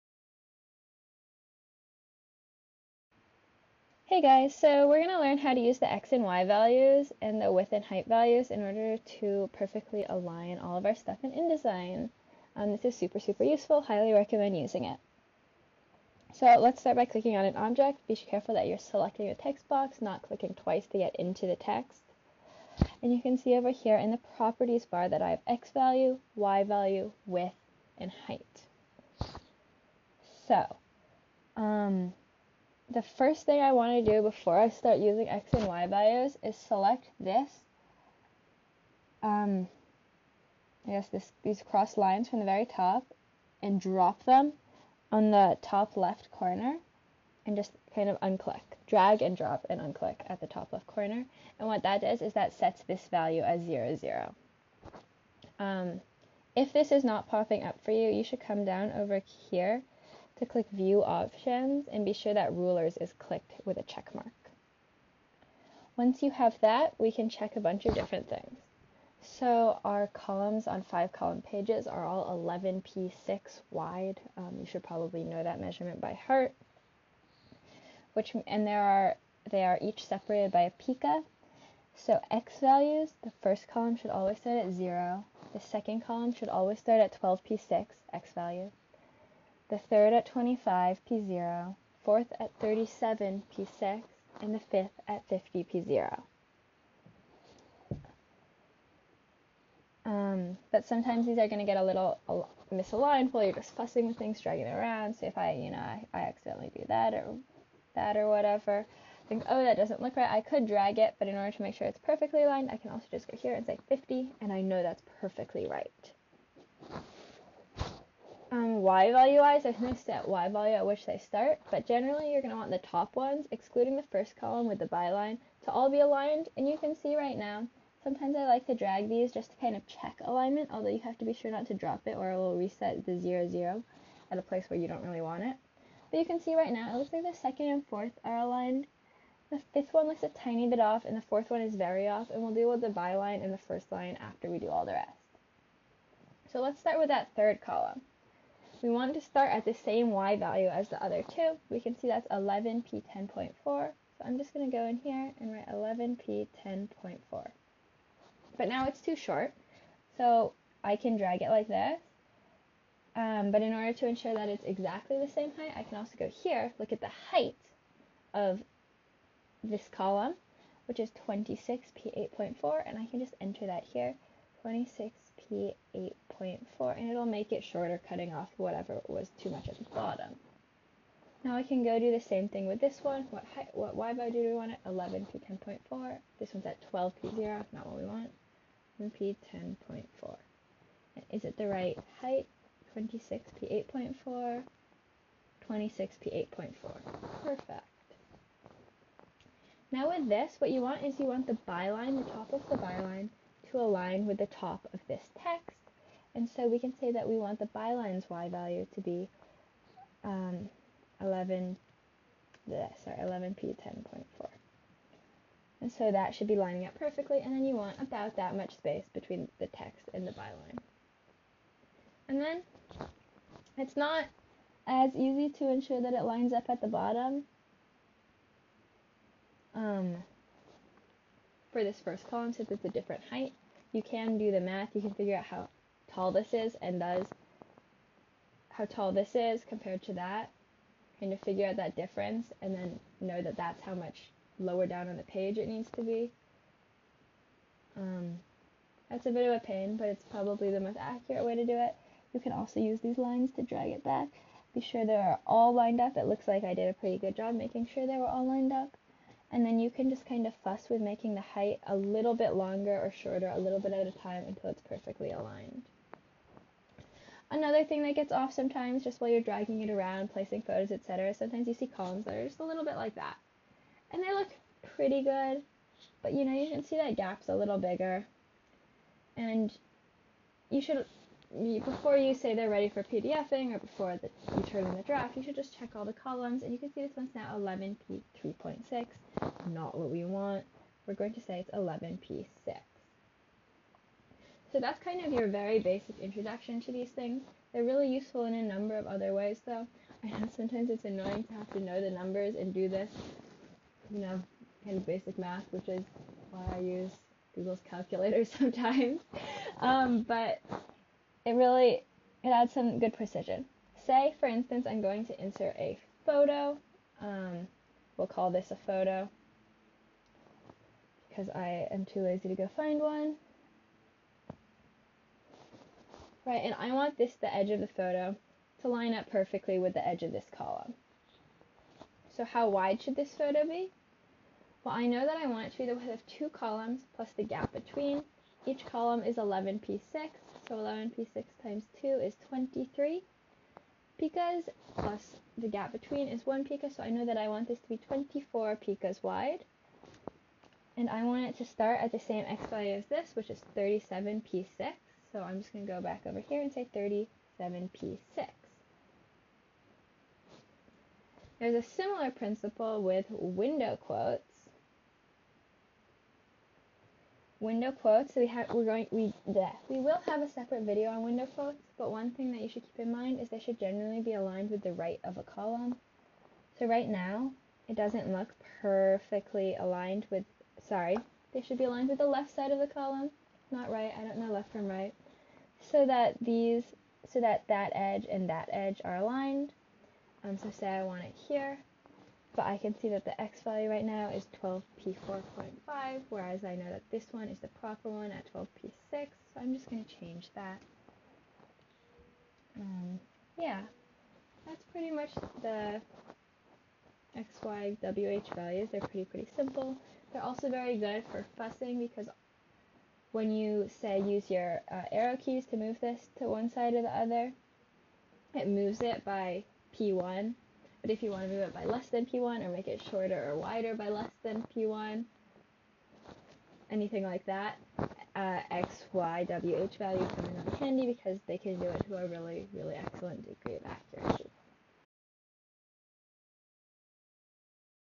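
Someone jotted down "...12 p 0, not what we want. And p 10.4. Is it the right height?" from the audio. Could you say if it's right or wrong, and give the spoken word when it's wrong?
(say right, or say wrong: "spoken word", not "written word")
right.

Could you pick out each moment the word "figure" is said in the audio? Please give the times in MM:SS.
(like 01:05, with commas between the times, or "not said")
03:55, 04:01.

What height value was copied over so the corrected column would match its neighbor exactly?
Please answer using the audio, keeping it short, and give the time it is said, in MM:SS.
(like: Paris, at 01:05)
26p8.4, at 02:51.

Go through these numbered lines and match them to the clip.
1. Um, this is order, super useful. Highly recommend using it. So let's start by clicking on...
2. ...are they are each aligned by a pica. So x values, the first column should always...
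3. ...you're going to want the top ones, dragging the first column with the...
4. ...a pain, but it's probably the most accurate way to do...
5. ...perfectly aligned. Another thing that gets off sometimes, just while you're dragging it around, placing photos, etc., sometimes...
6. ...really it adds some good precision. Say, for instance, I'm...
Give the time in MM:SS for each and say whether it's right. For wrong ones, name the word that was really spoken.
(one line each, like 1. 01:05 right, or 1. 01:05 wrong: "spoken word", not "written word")
1. 00:12 wrong: "super", not "order"
2. 01:18 wrong: "separated", not "aligned"
3. 02:02 wrong: "excluding", not "dragging"
4. 04:09 right
5. 04:24 right
6. 05:11 right.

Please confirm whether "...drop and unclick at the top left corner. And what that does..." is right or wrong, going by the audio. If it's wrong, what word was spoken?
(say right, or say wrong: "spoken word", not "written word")
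right.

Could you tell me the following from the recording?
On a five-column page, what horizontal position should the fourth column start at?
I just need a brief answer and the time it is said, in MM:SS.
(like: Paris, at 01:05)
37p6, at 01:32.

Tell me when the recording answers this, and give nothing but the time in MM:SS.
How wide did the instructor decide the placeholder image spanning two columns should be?
05:47.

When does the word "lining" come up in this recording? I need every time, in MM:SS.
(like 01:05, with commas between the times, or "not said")
03:36.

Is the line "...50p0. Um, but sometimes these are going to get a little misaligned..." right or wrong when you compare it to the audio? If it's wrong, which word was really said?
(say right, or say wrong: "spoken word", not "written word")
right.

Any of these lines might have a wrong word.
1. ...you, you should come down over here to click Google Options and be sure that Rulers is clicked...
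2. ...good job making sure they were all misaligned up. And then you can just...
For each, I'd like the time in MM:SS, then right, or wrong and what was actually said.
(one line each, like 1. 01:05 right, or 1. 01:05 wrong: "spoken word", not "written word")
1. 00:57 wrong: "View", not "Google"
2. 04:17 wrong: "lined", not "misaligned".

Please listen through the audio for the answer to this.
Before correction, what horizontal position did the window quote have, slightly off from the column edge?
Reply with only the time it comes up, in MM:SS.
06:34.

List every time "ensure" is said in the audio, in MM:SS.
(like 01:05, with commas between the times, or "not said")
02:44, 03:45.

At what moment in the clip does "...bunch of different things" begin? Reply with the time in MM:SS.
01:07.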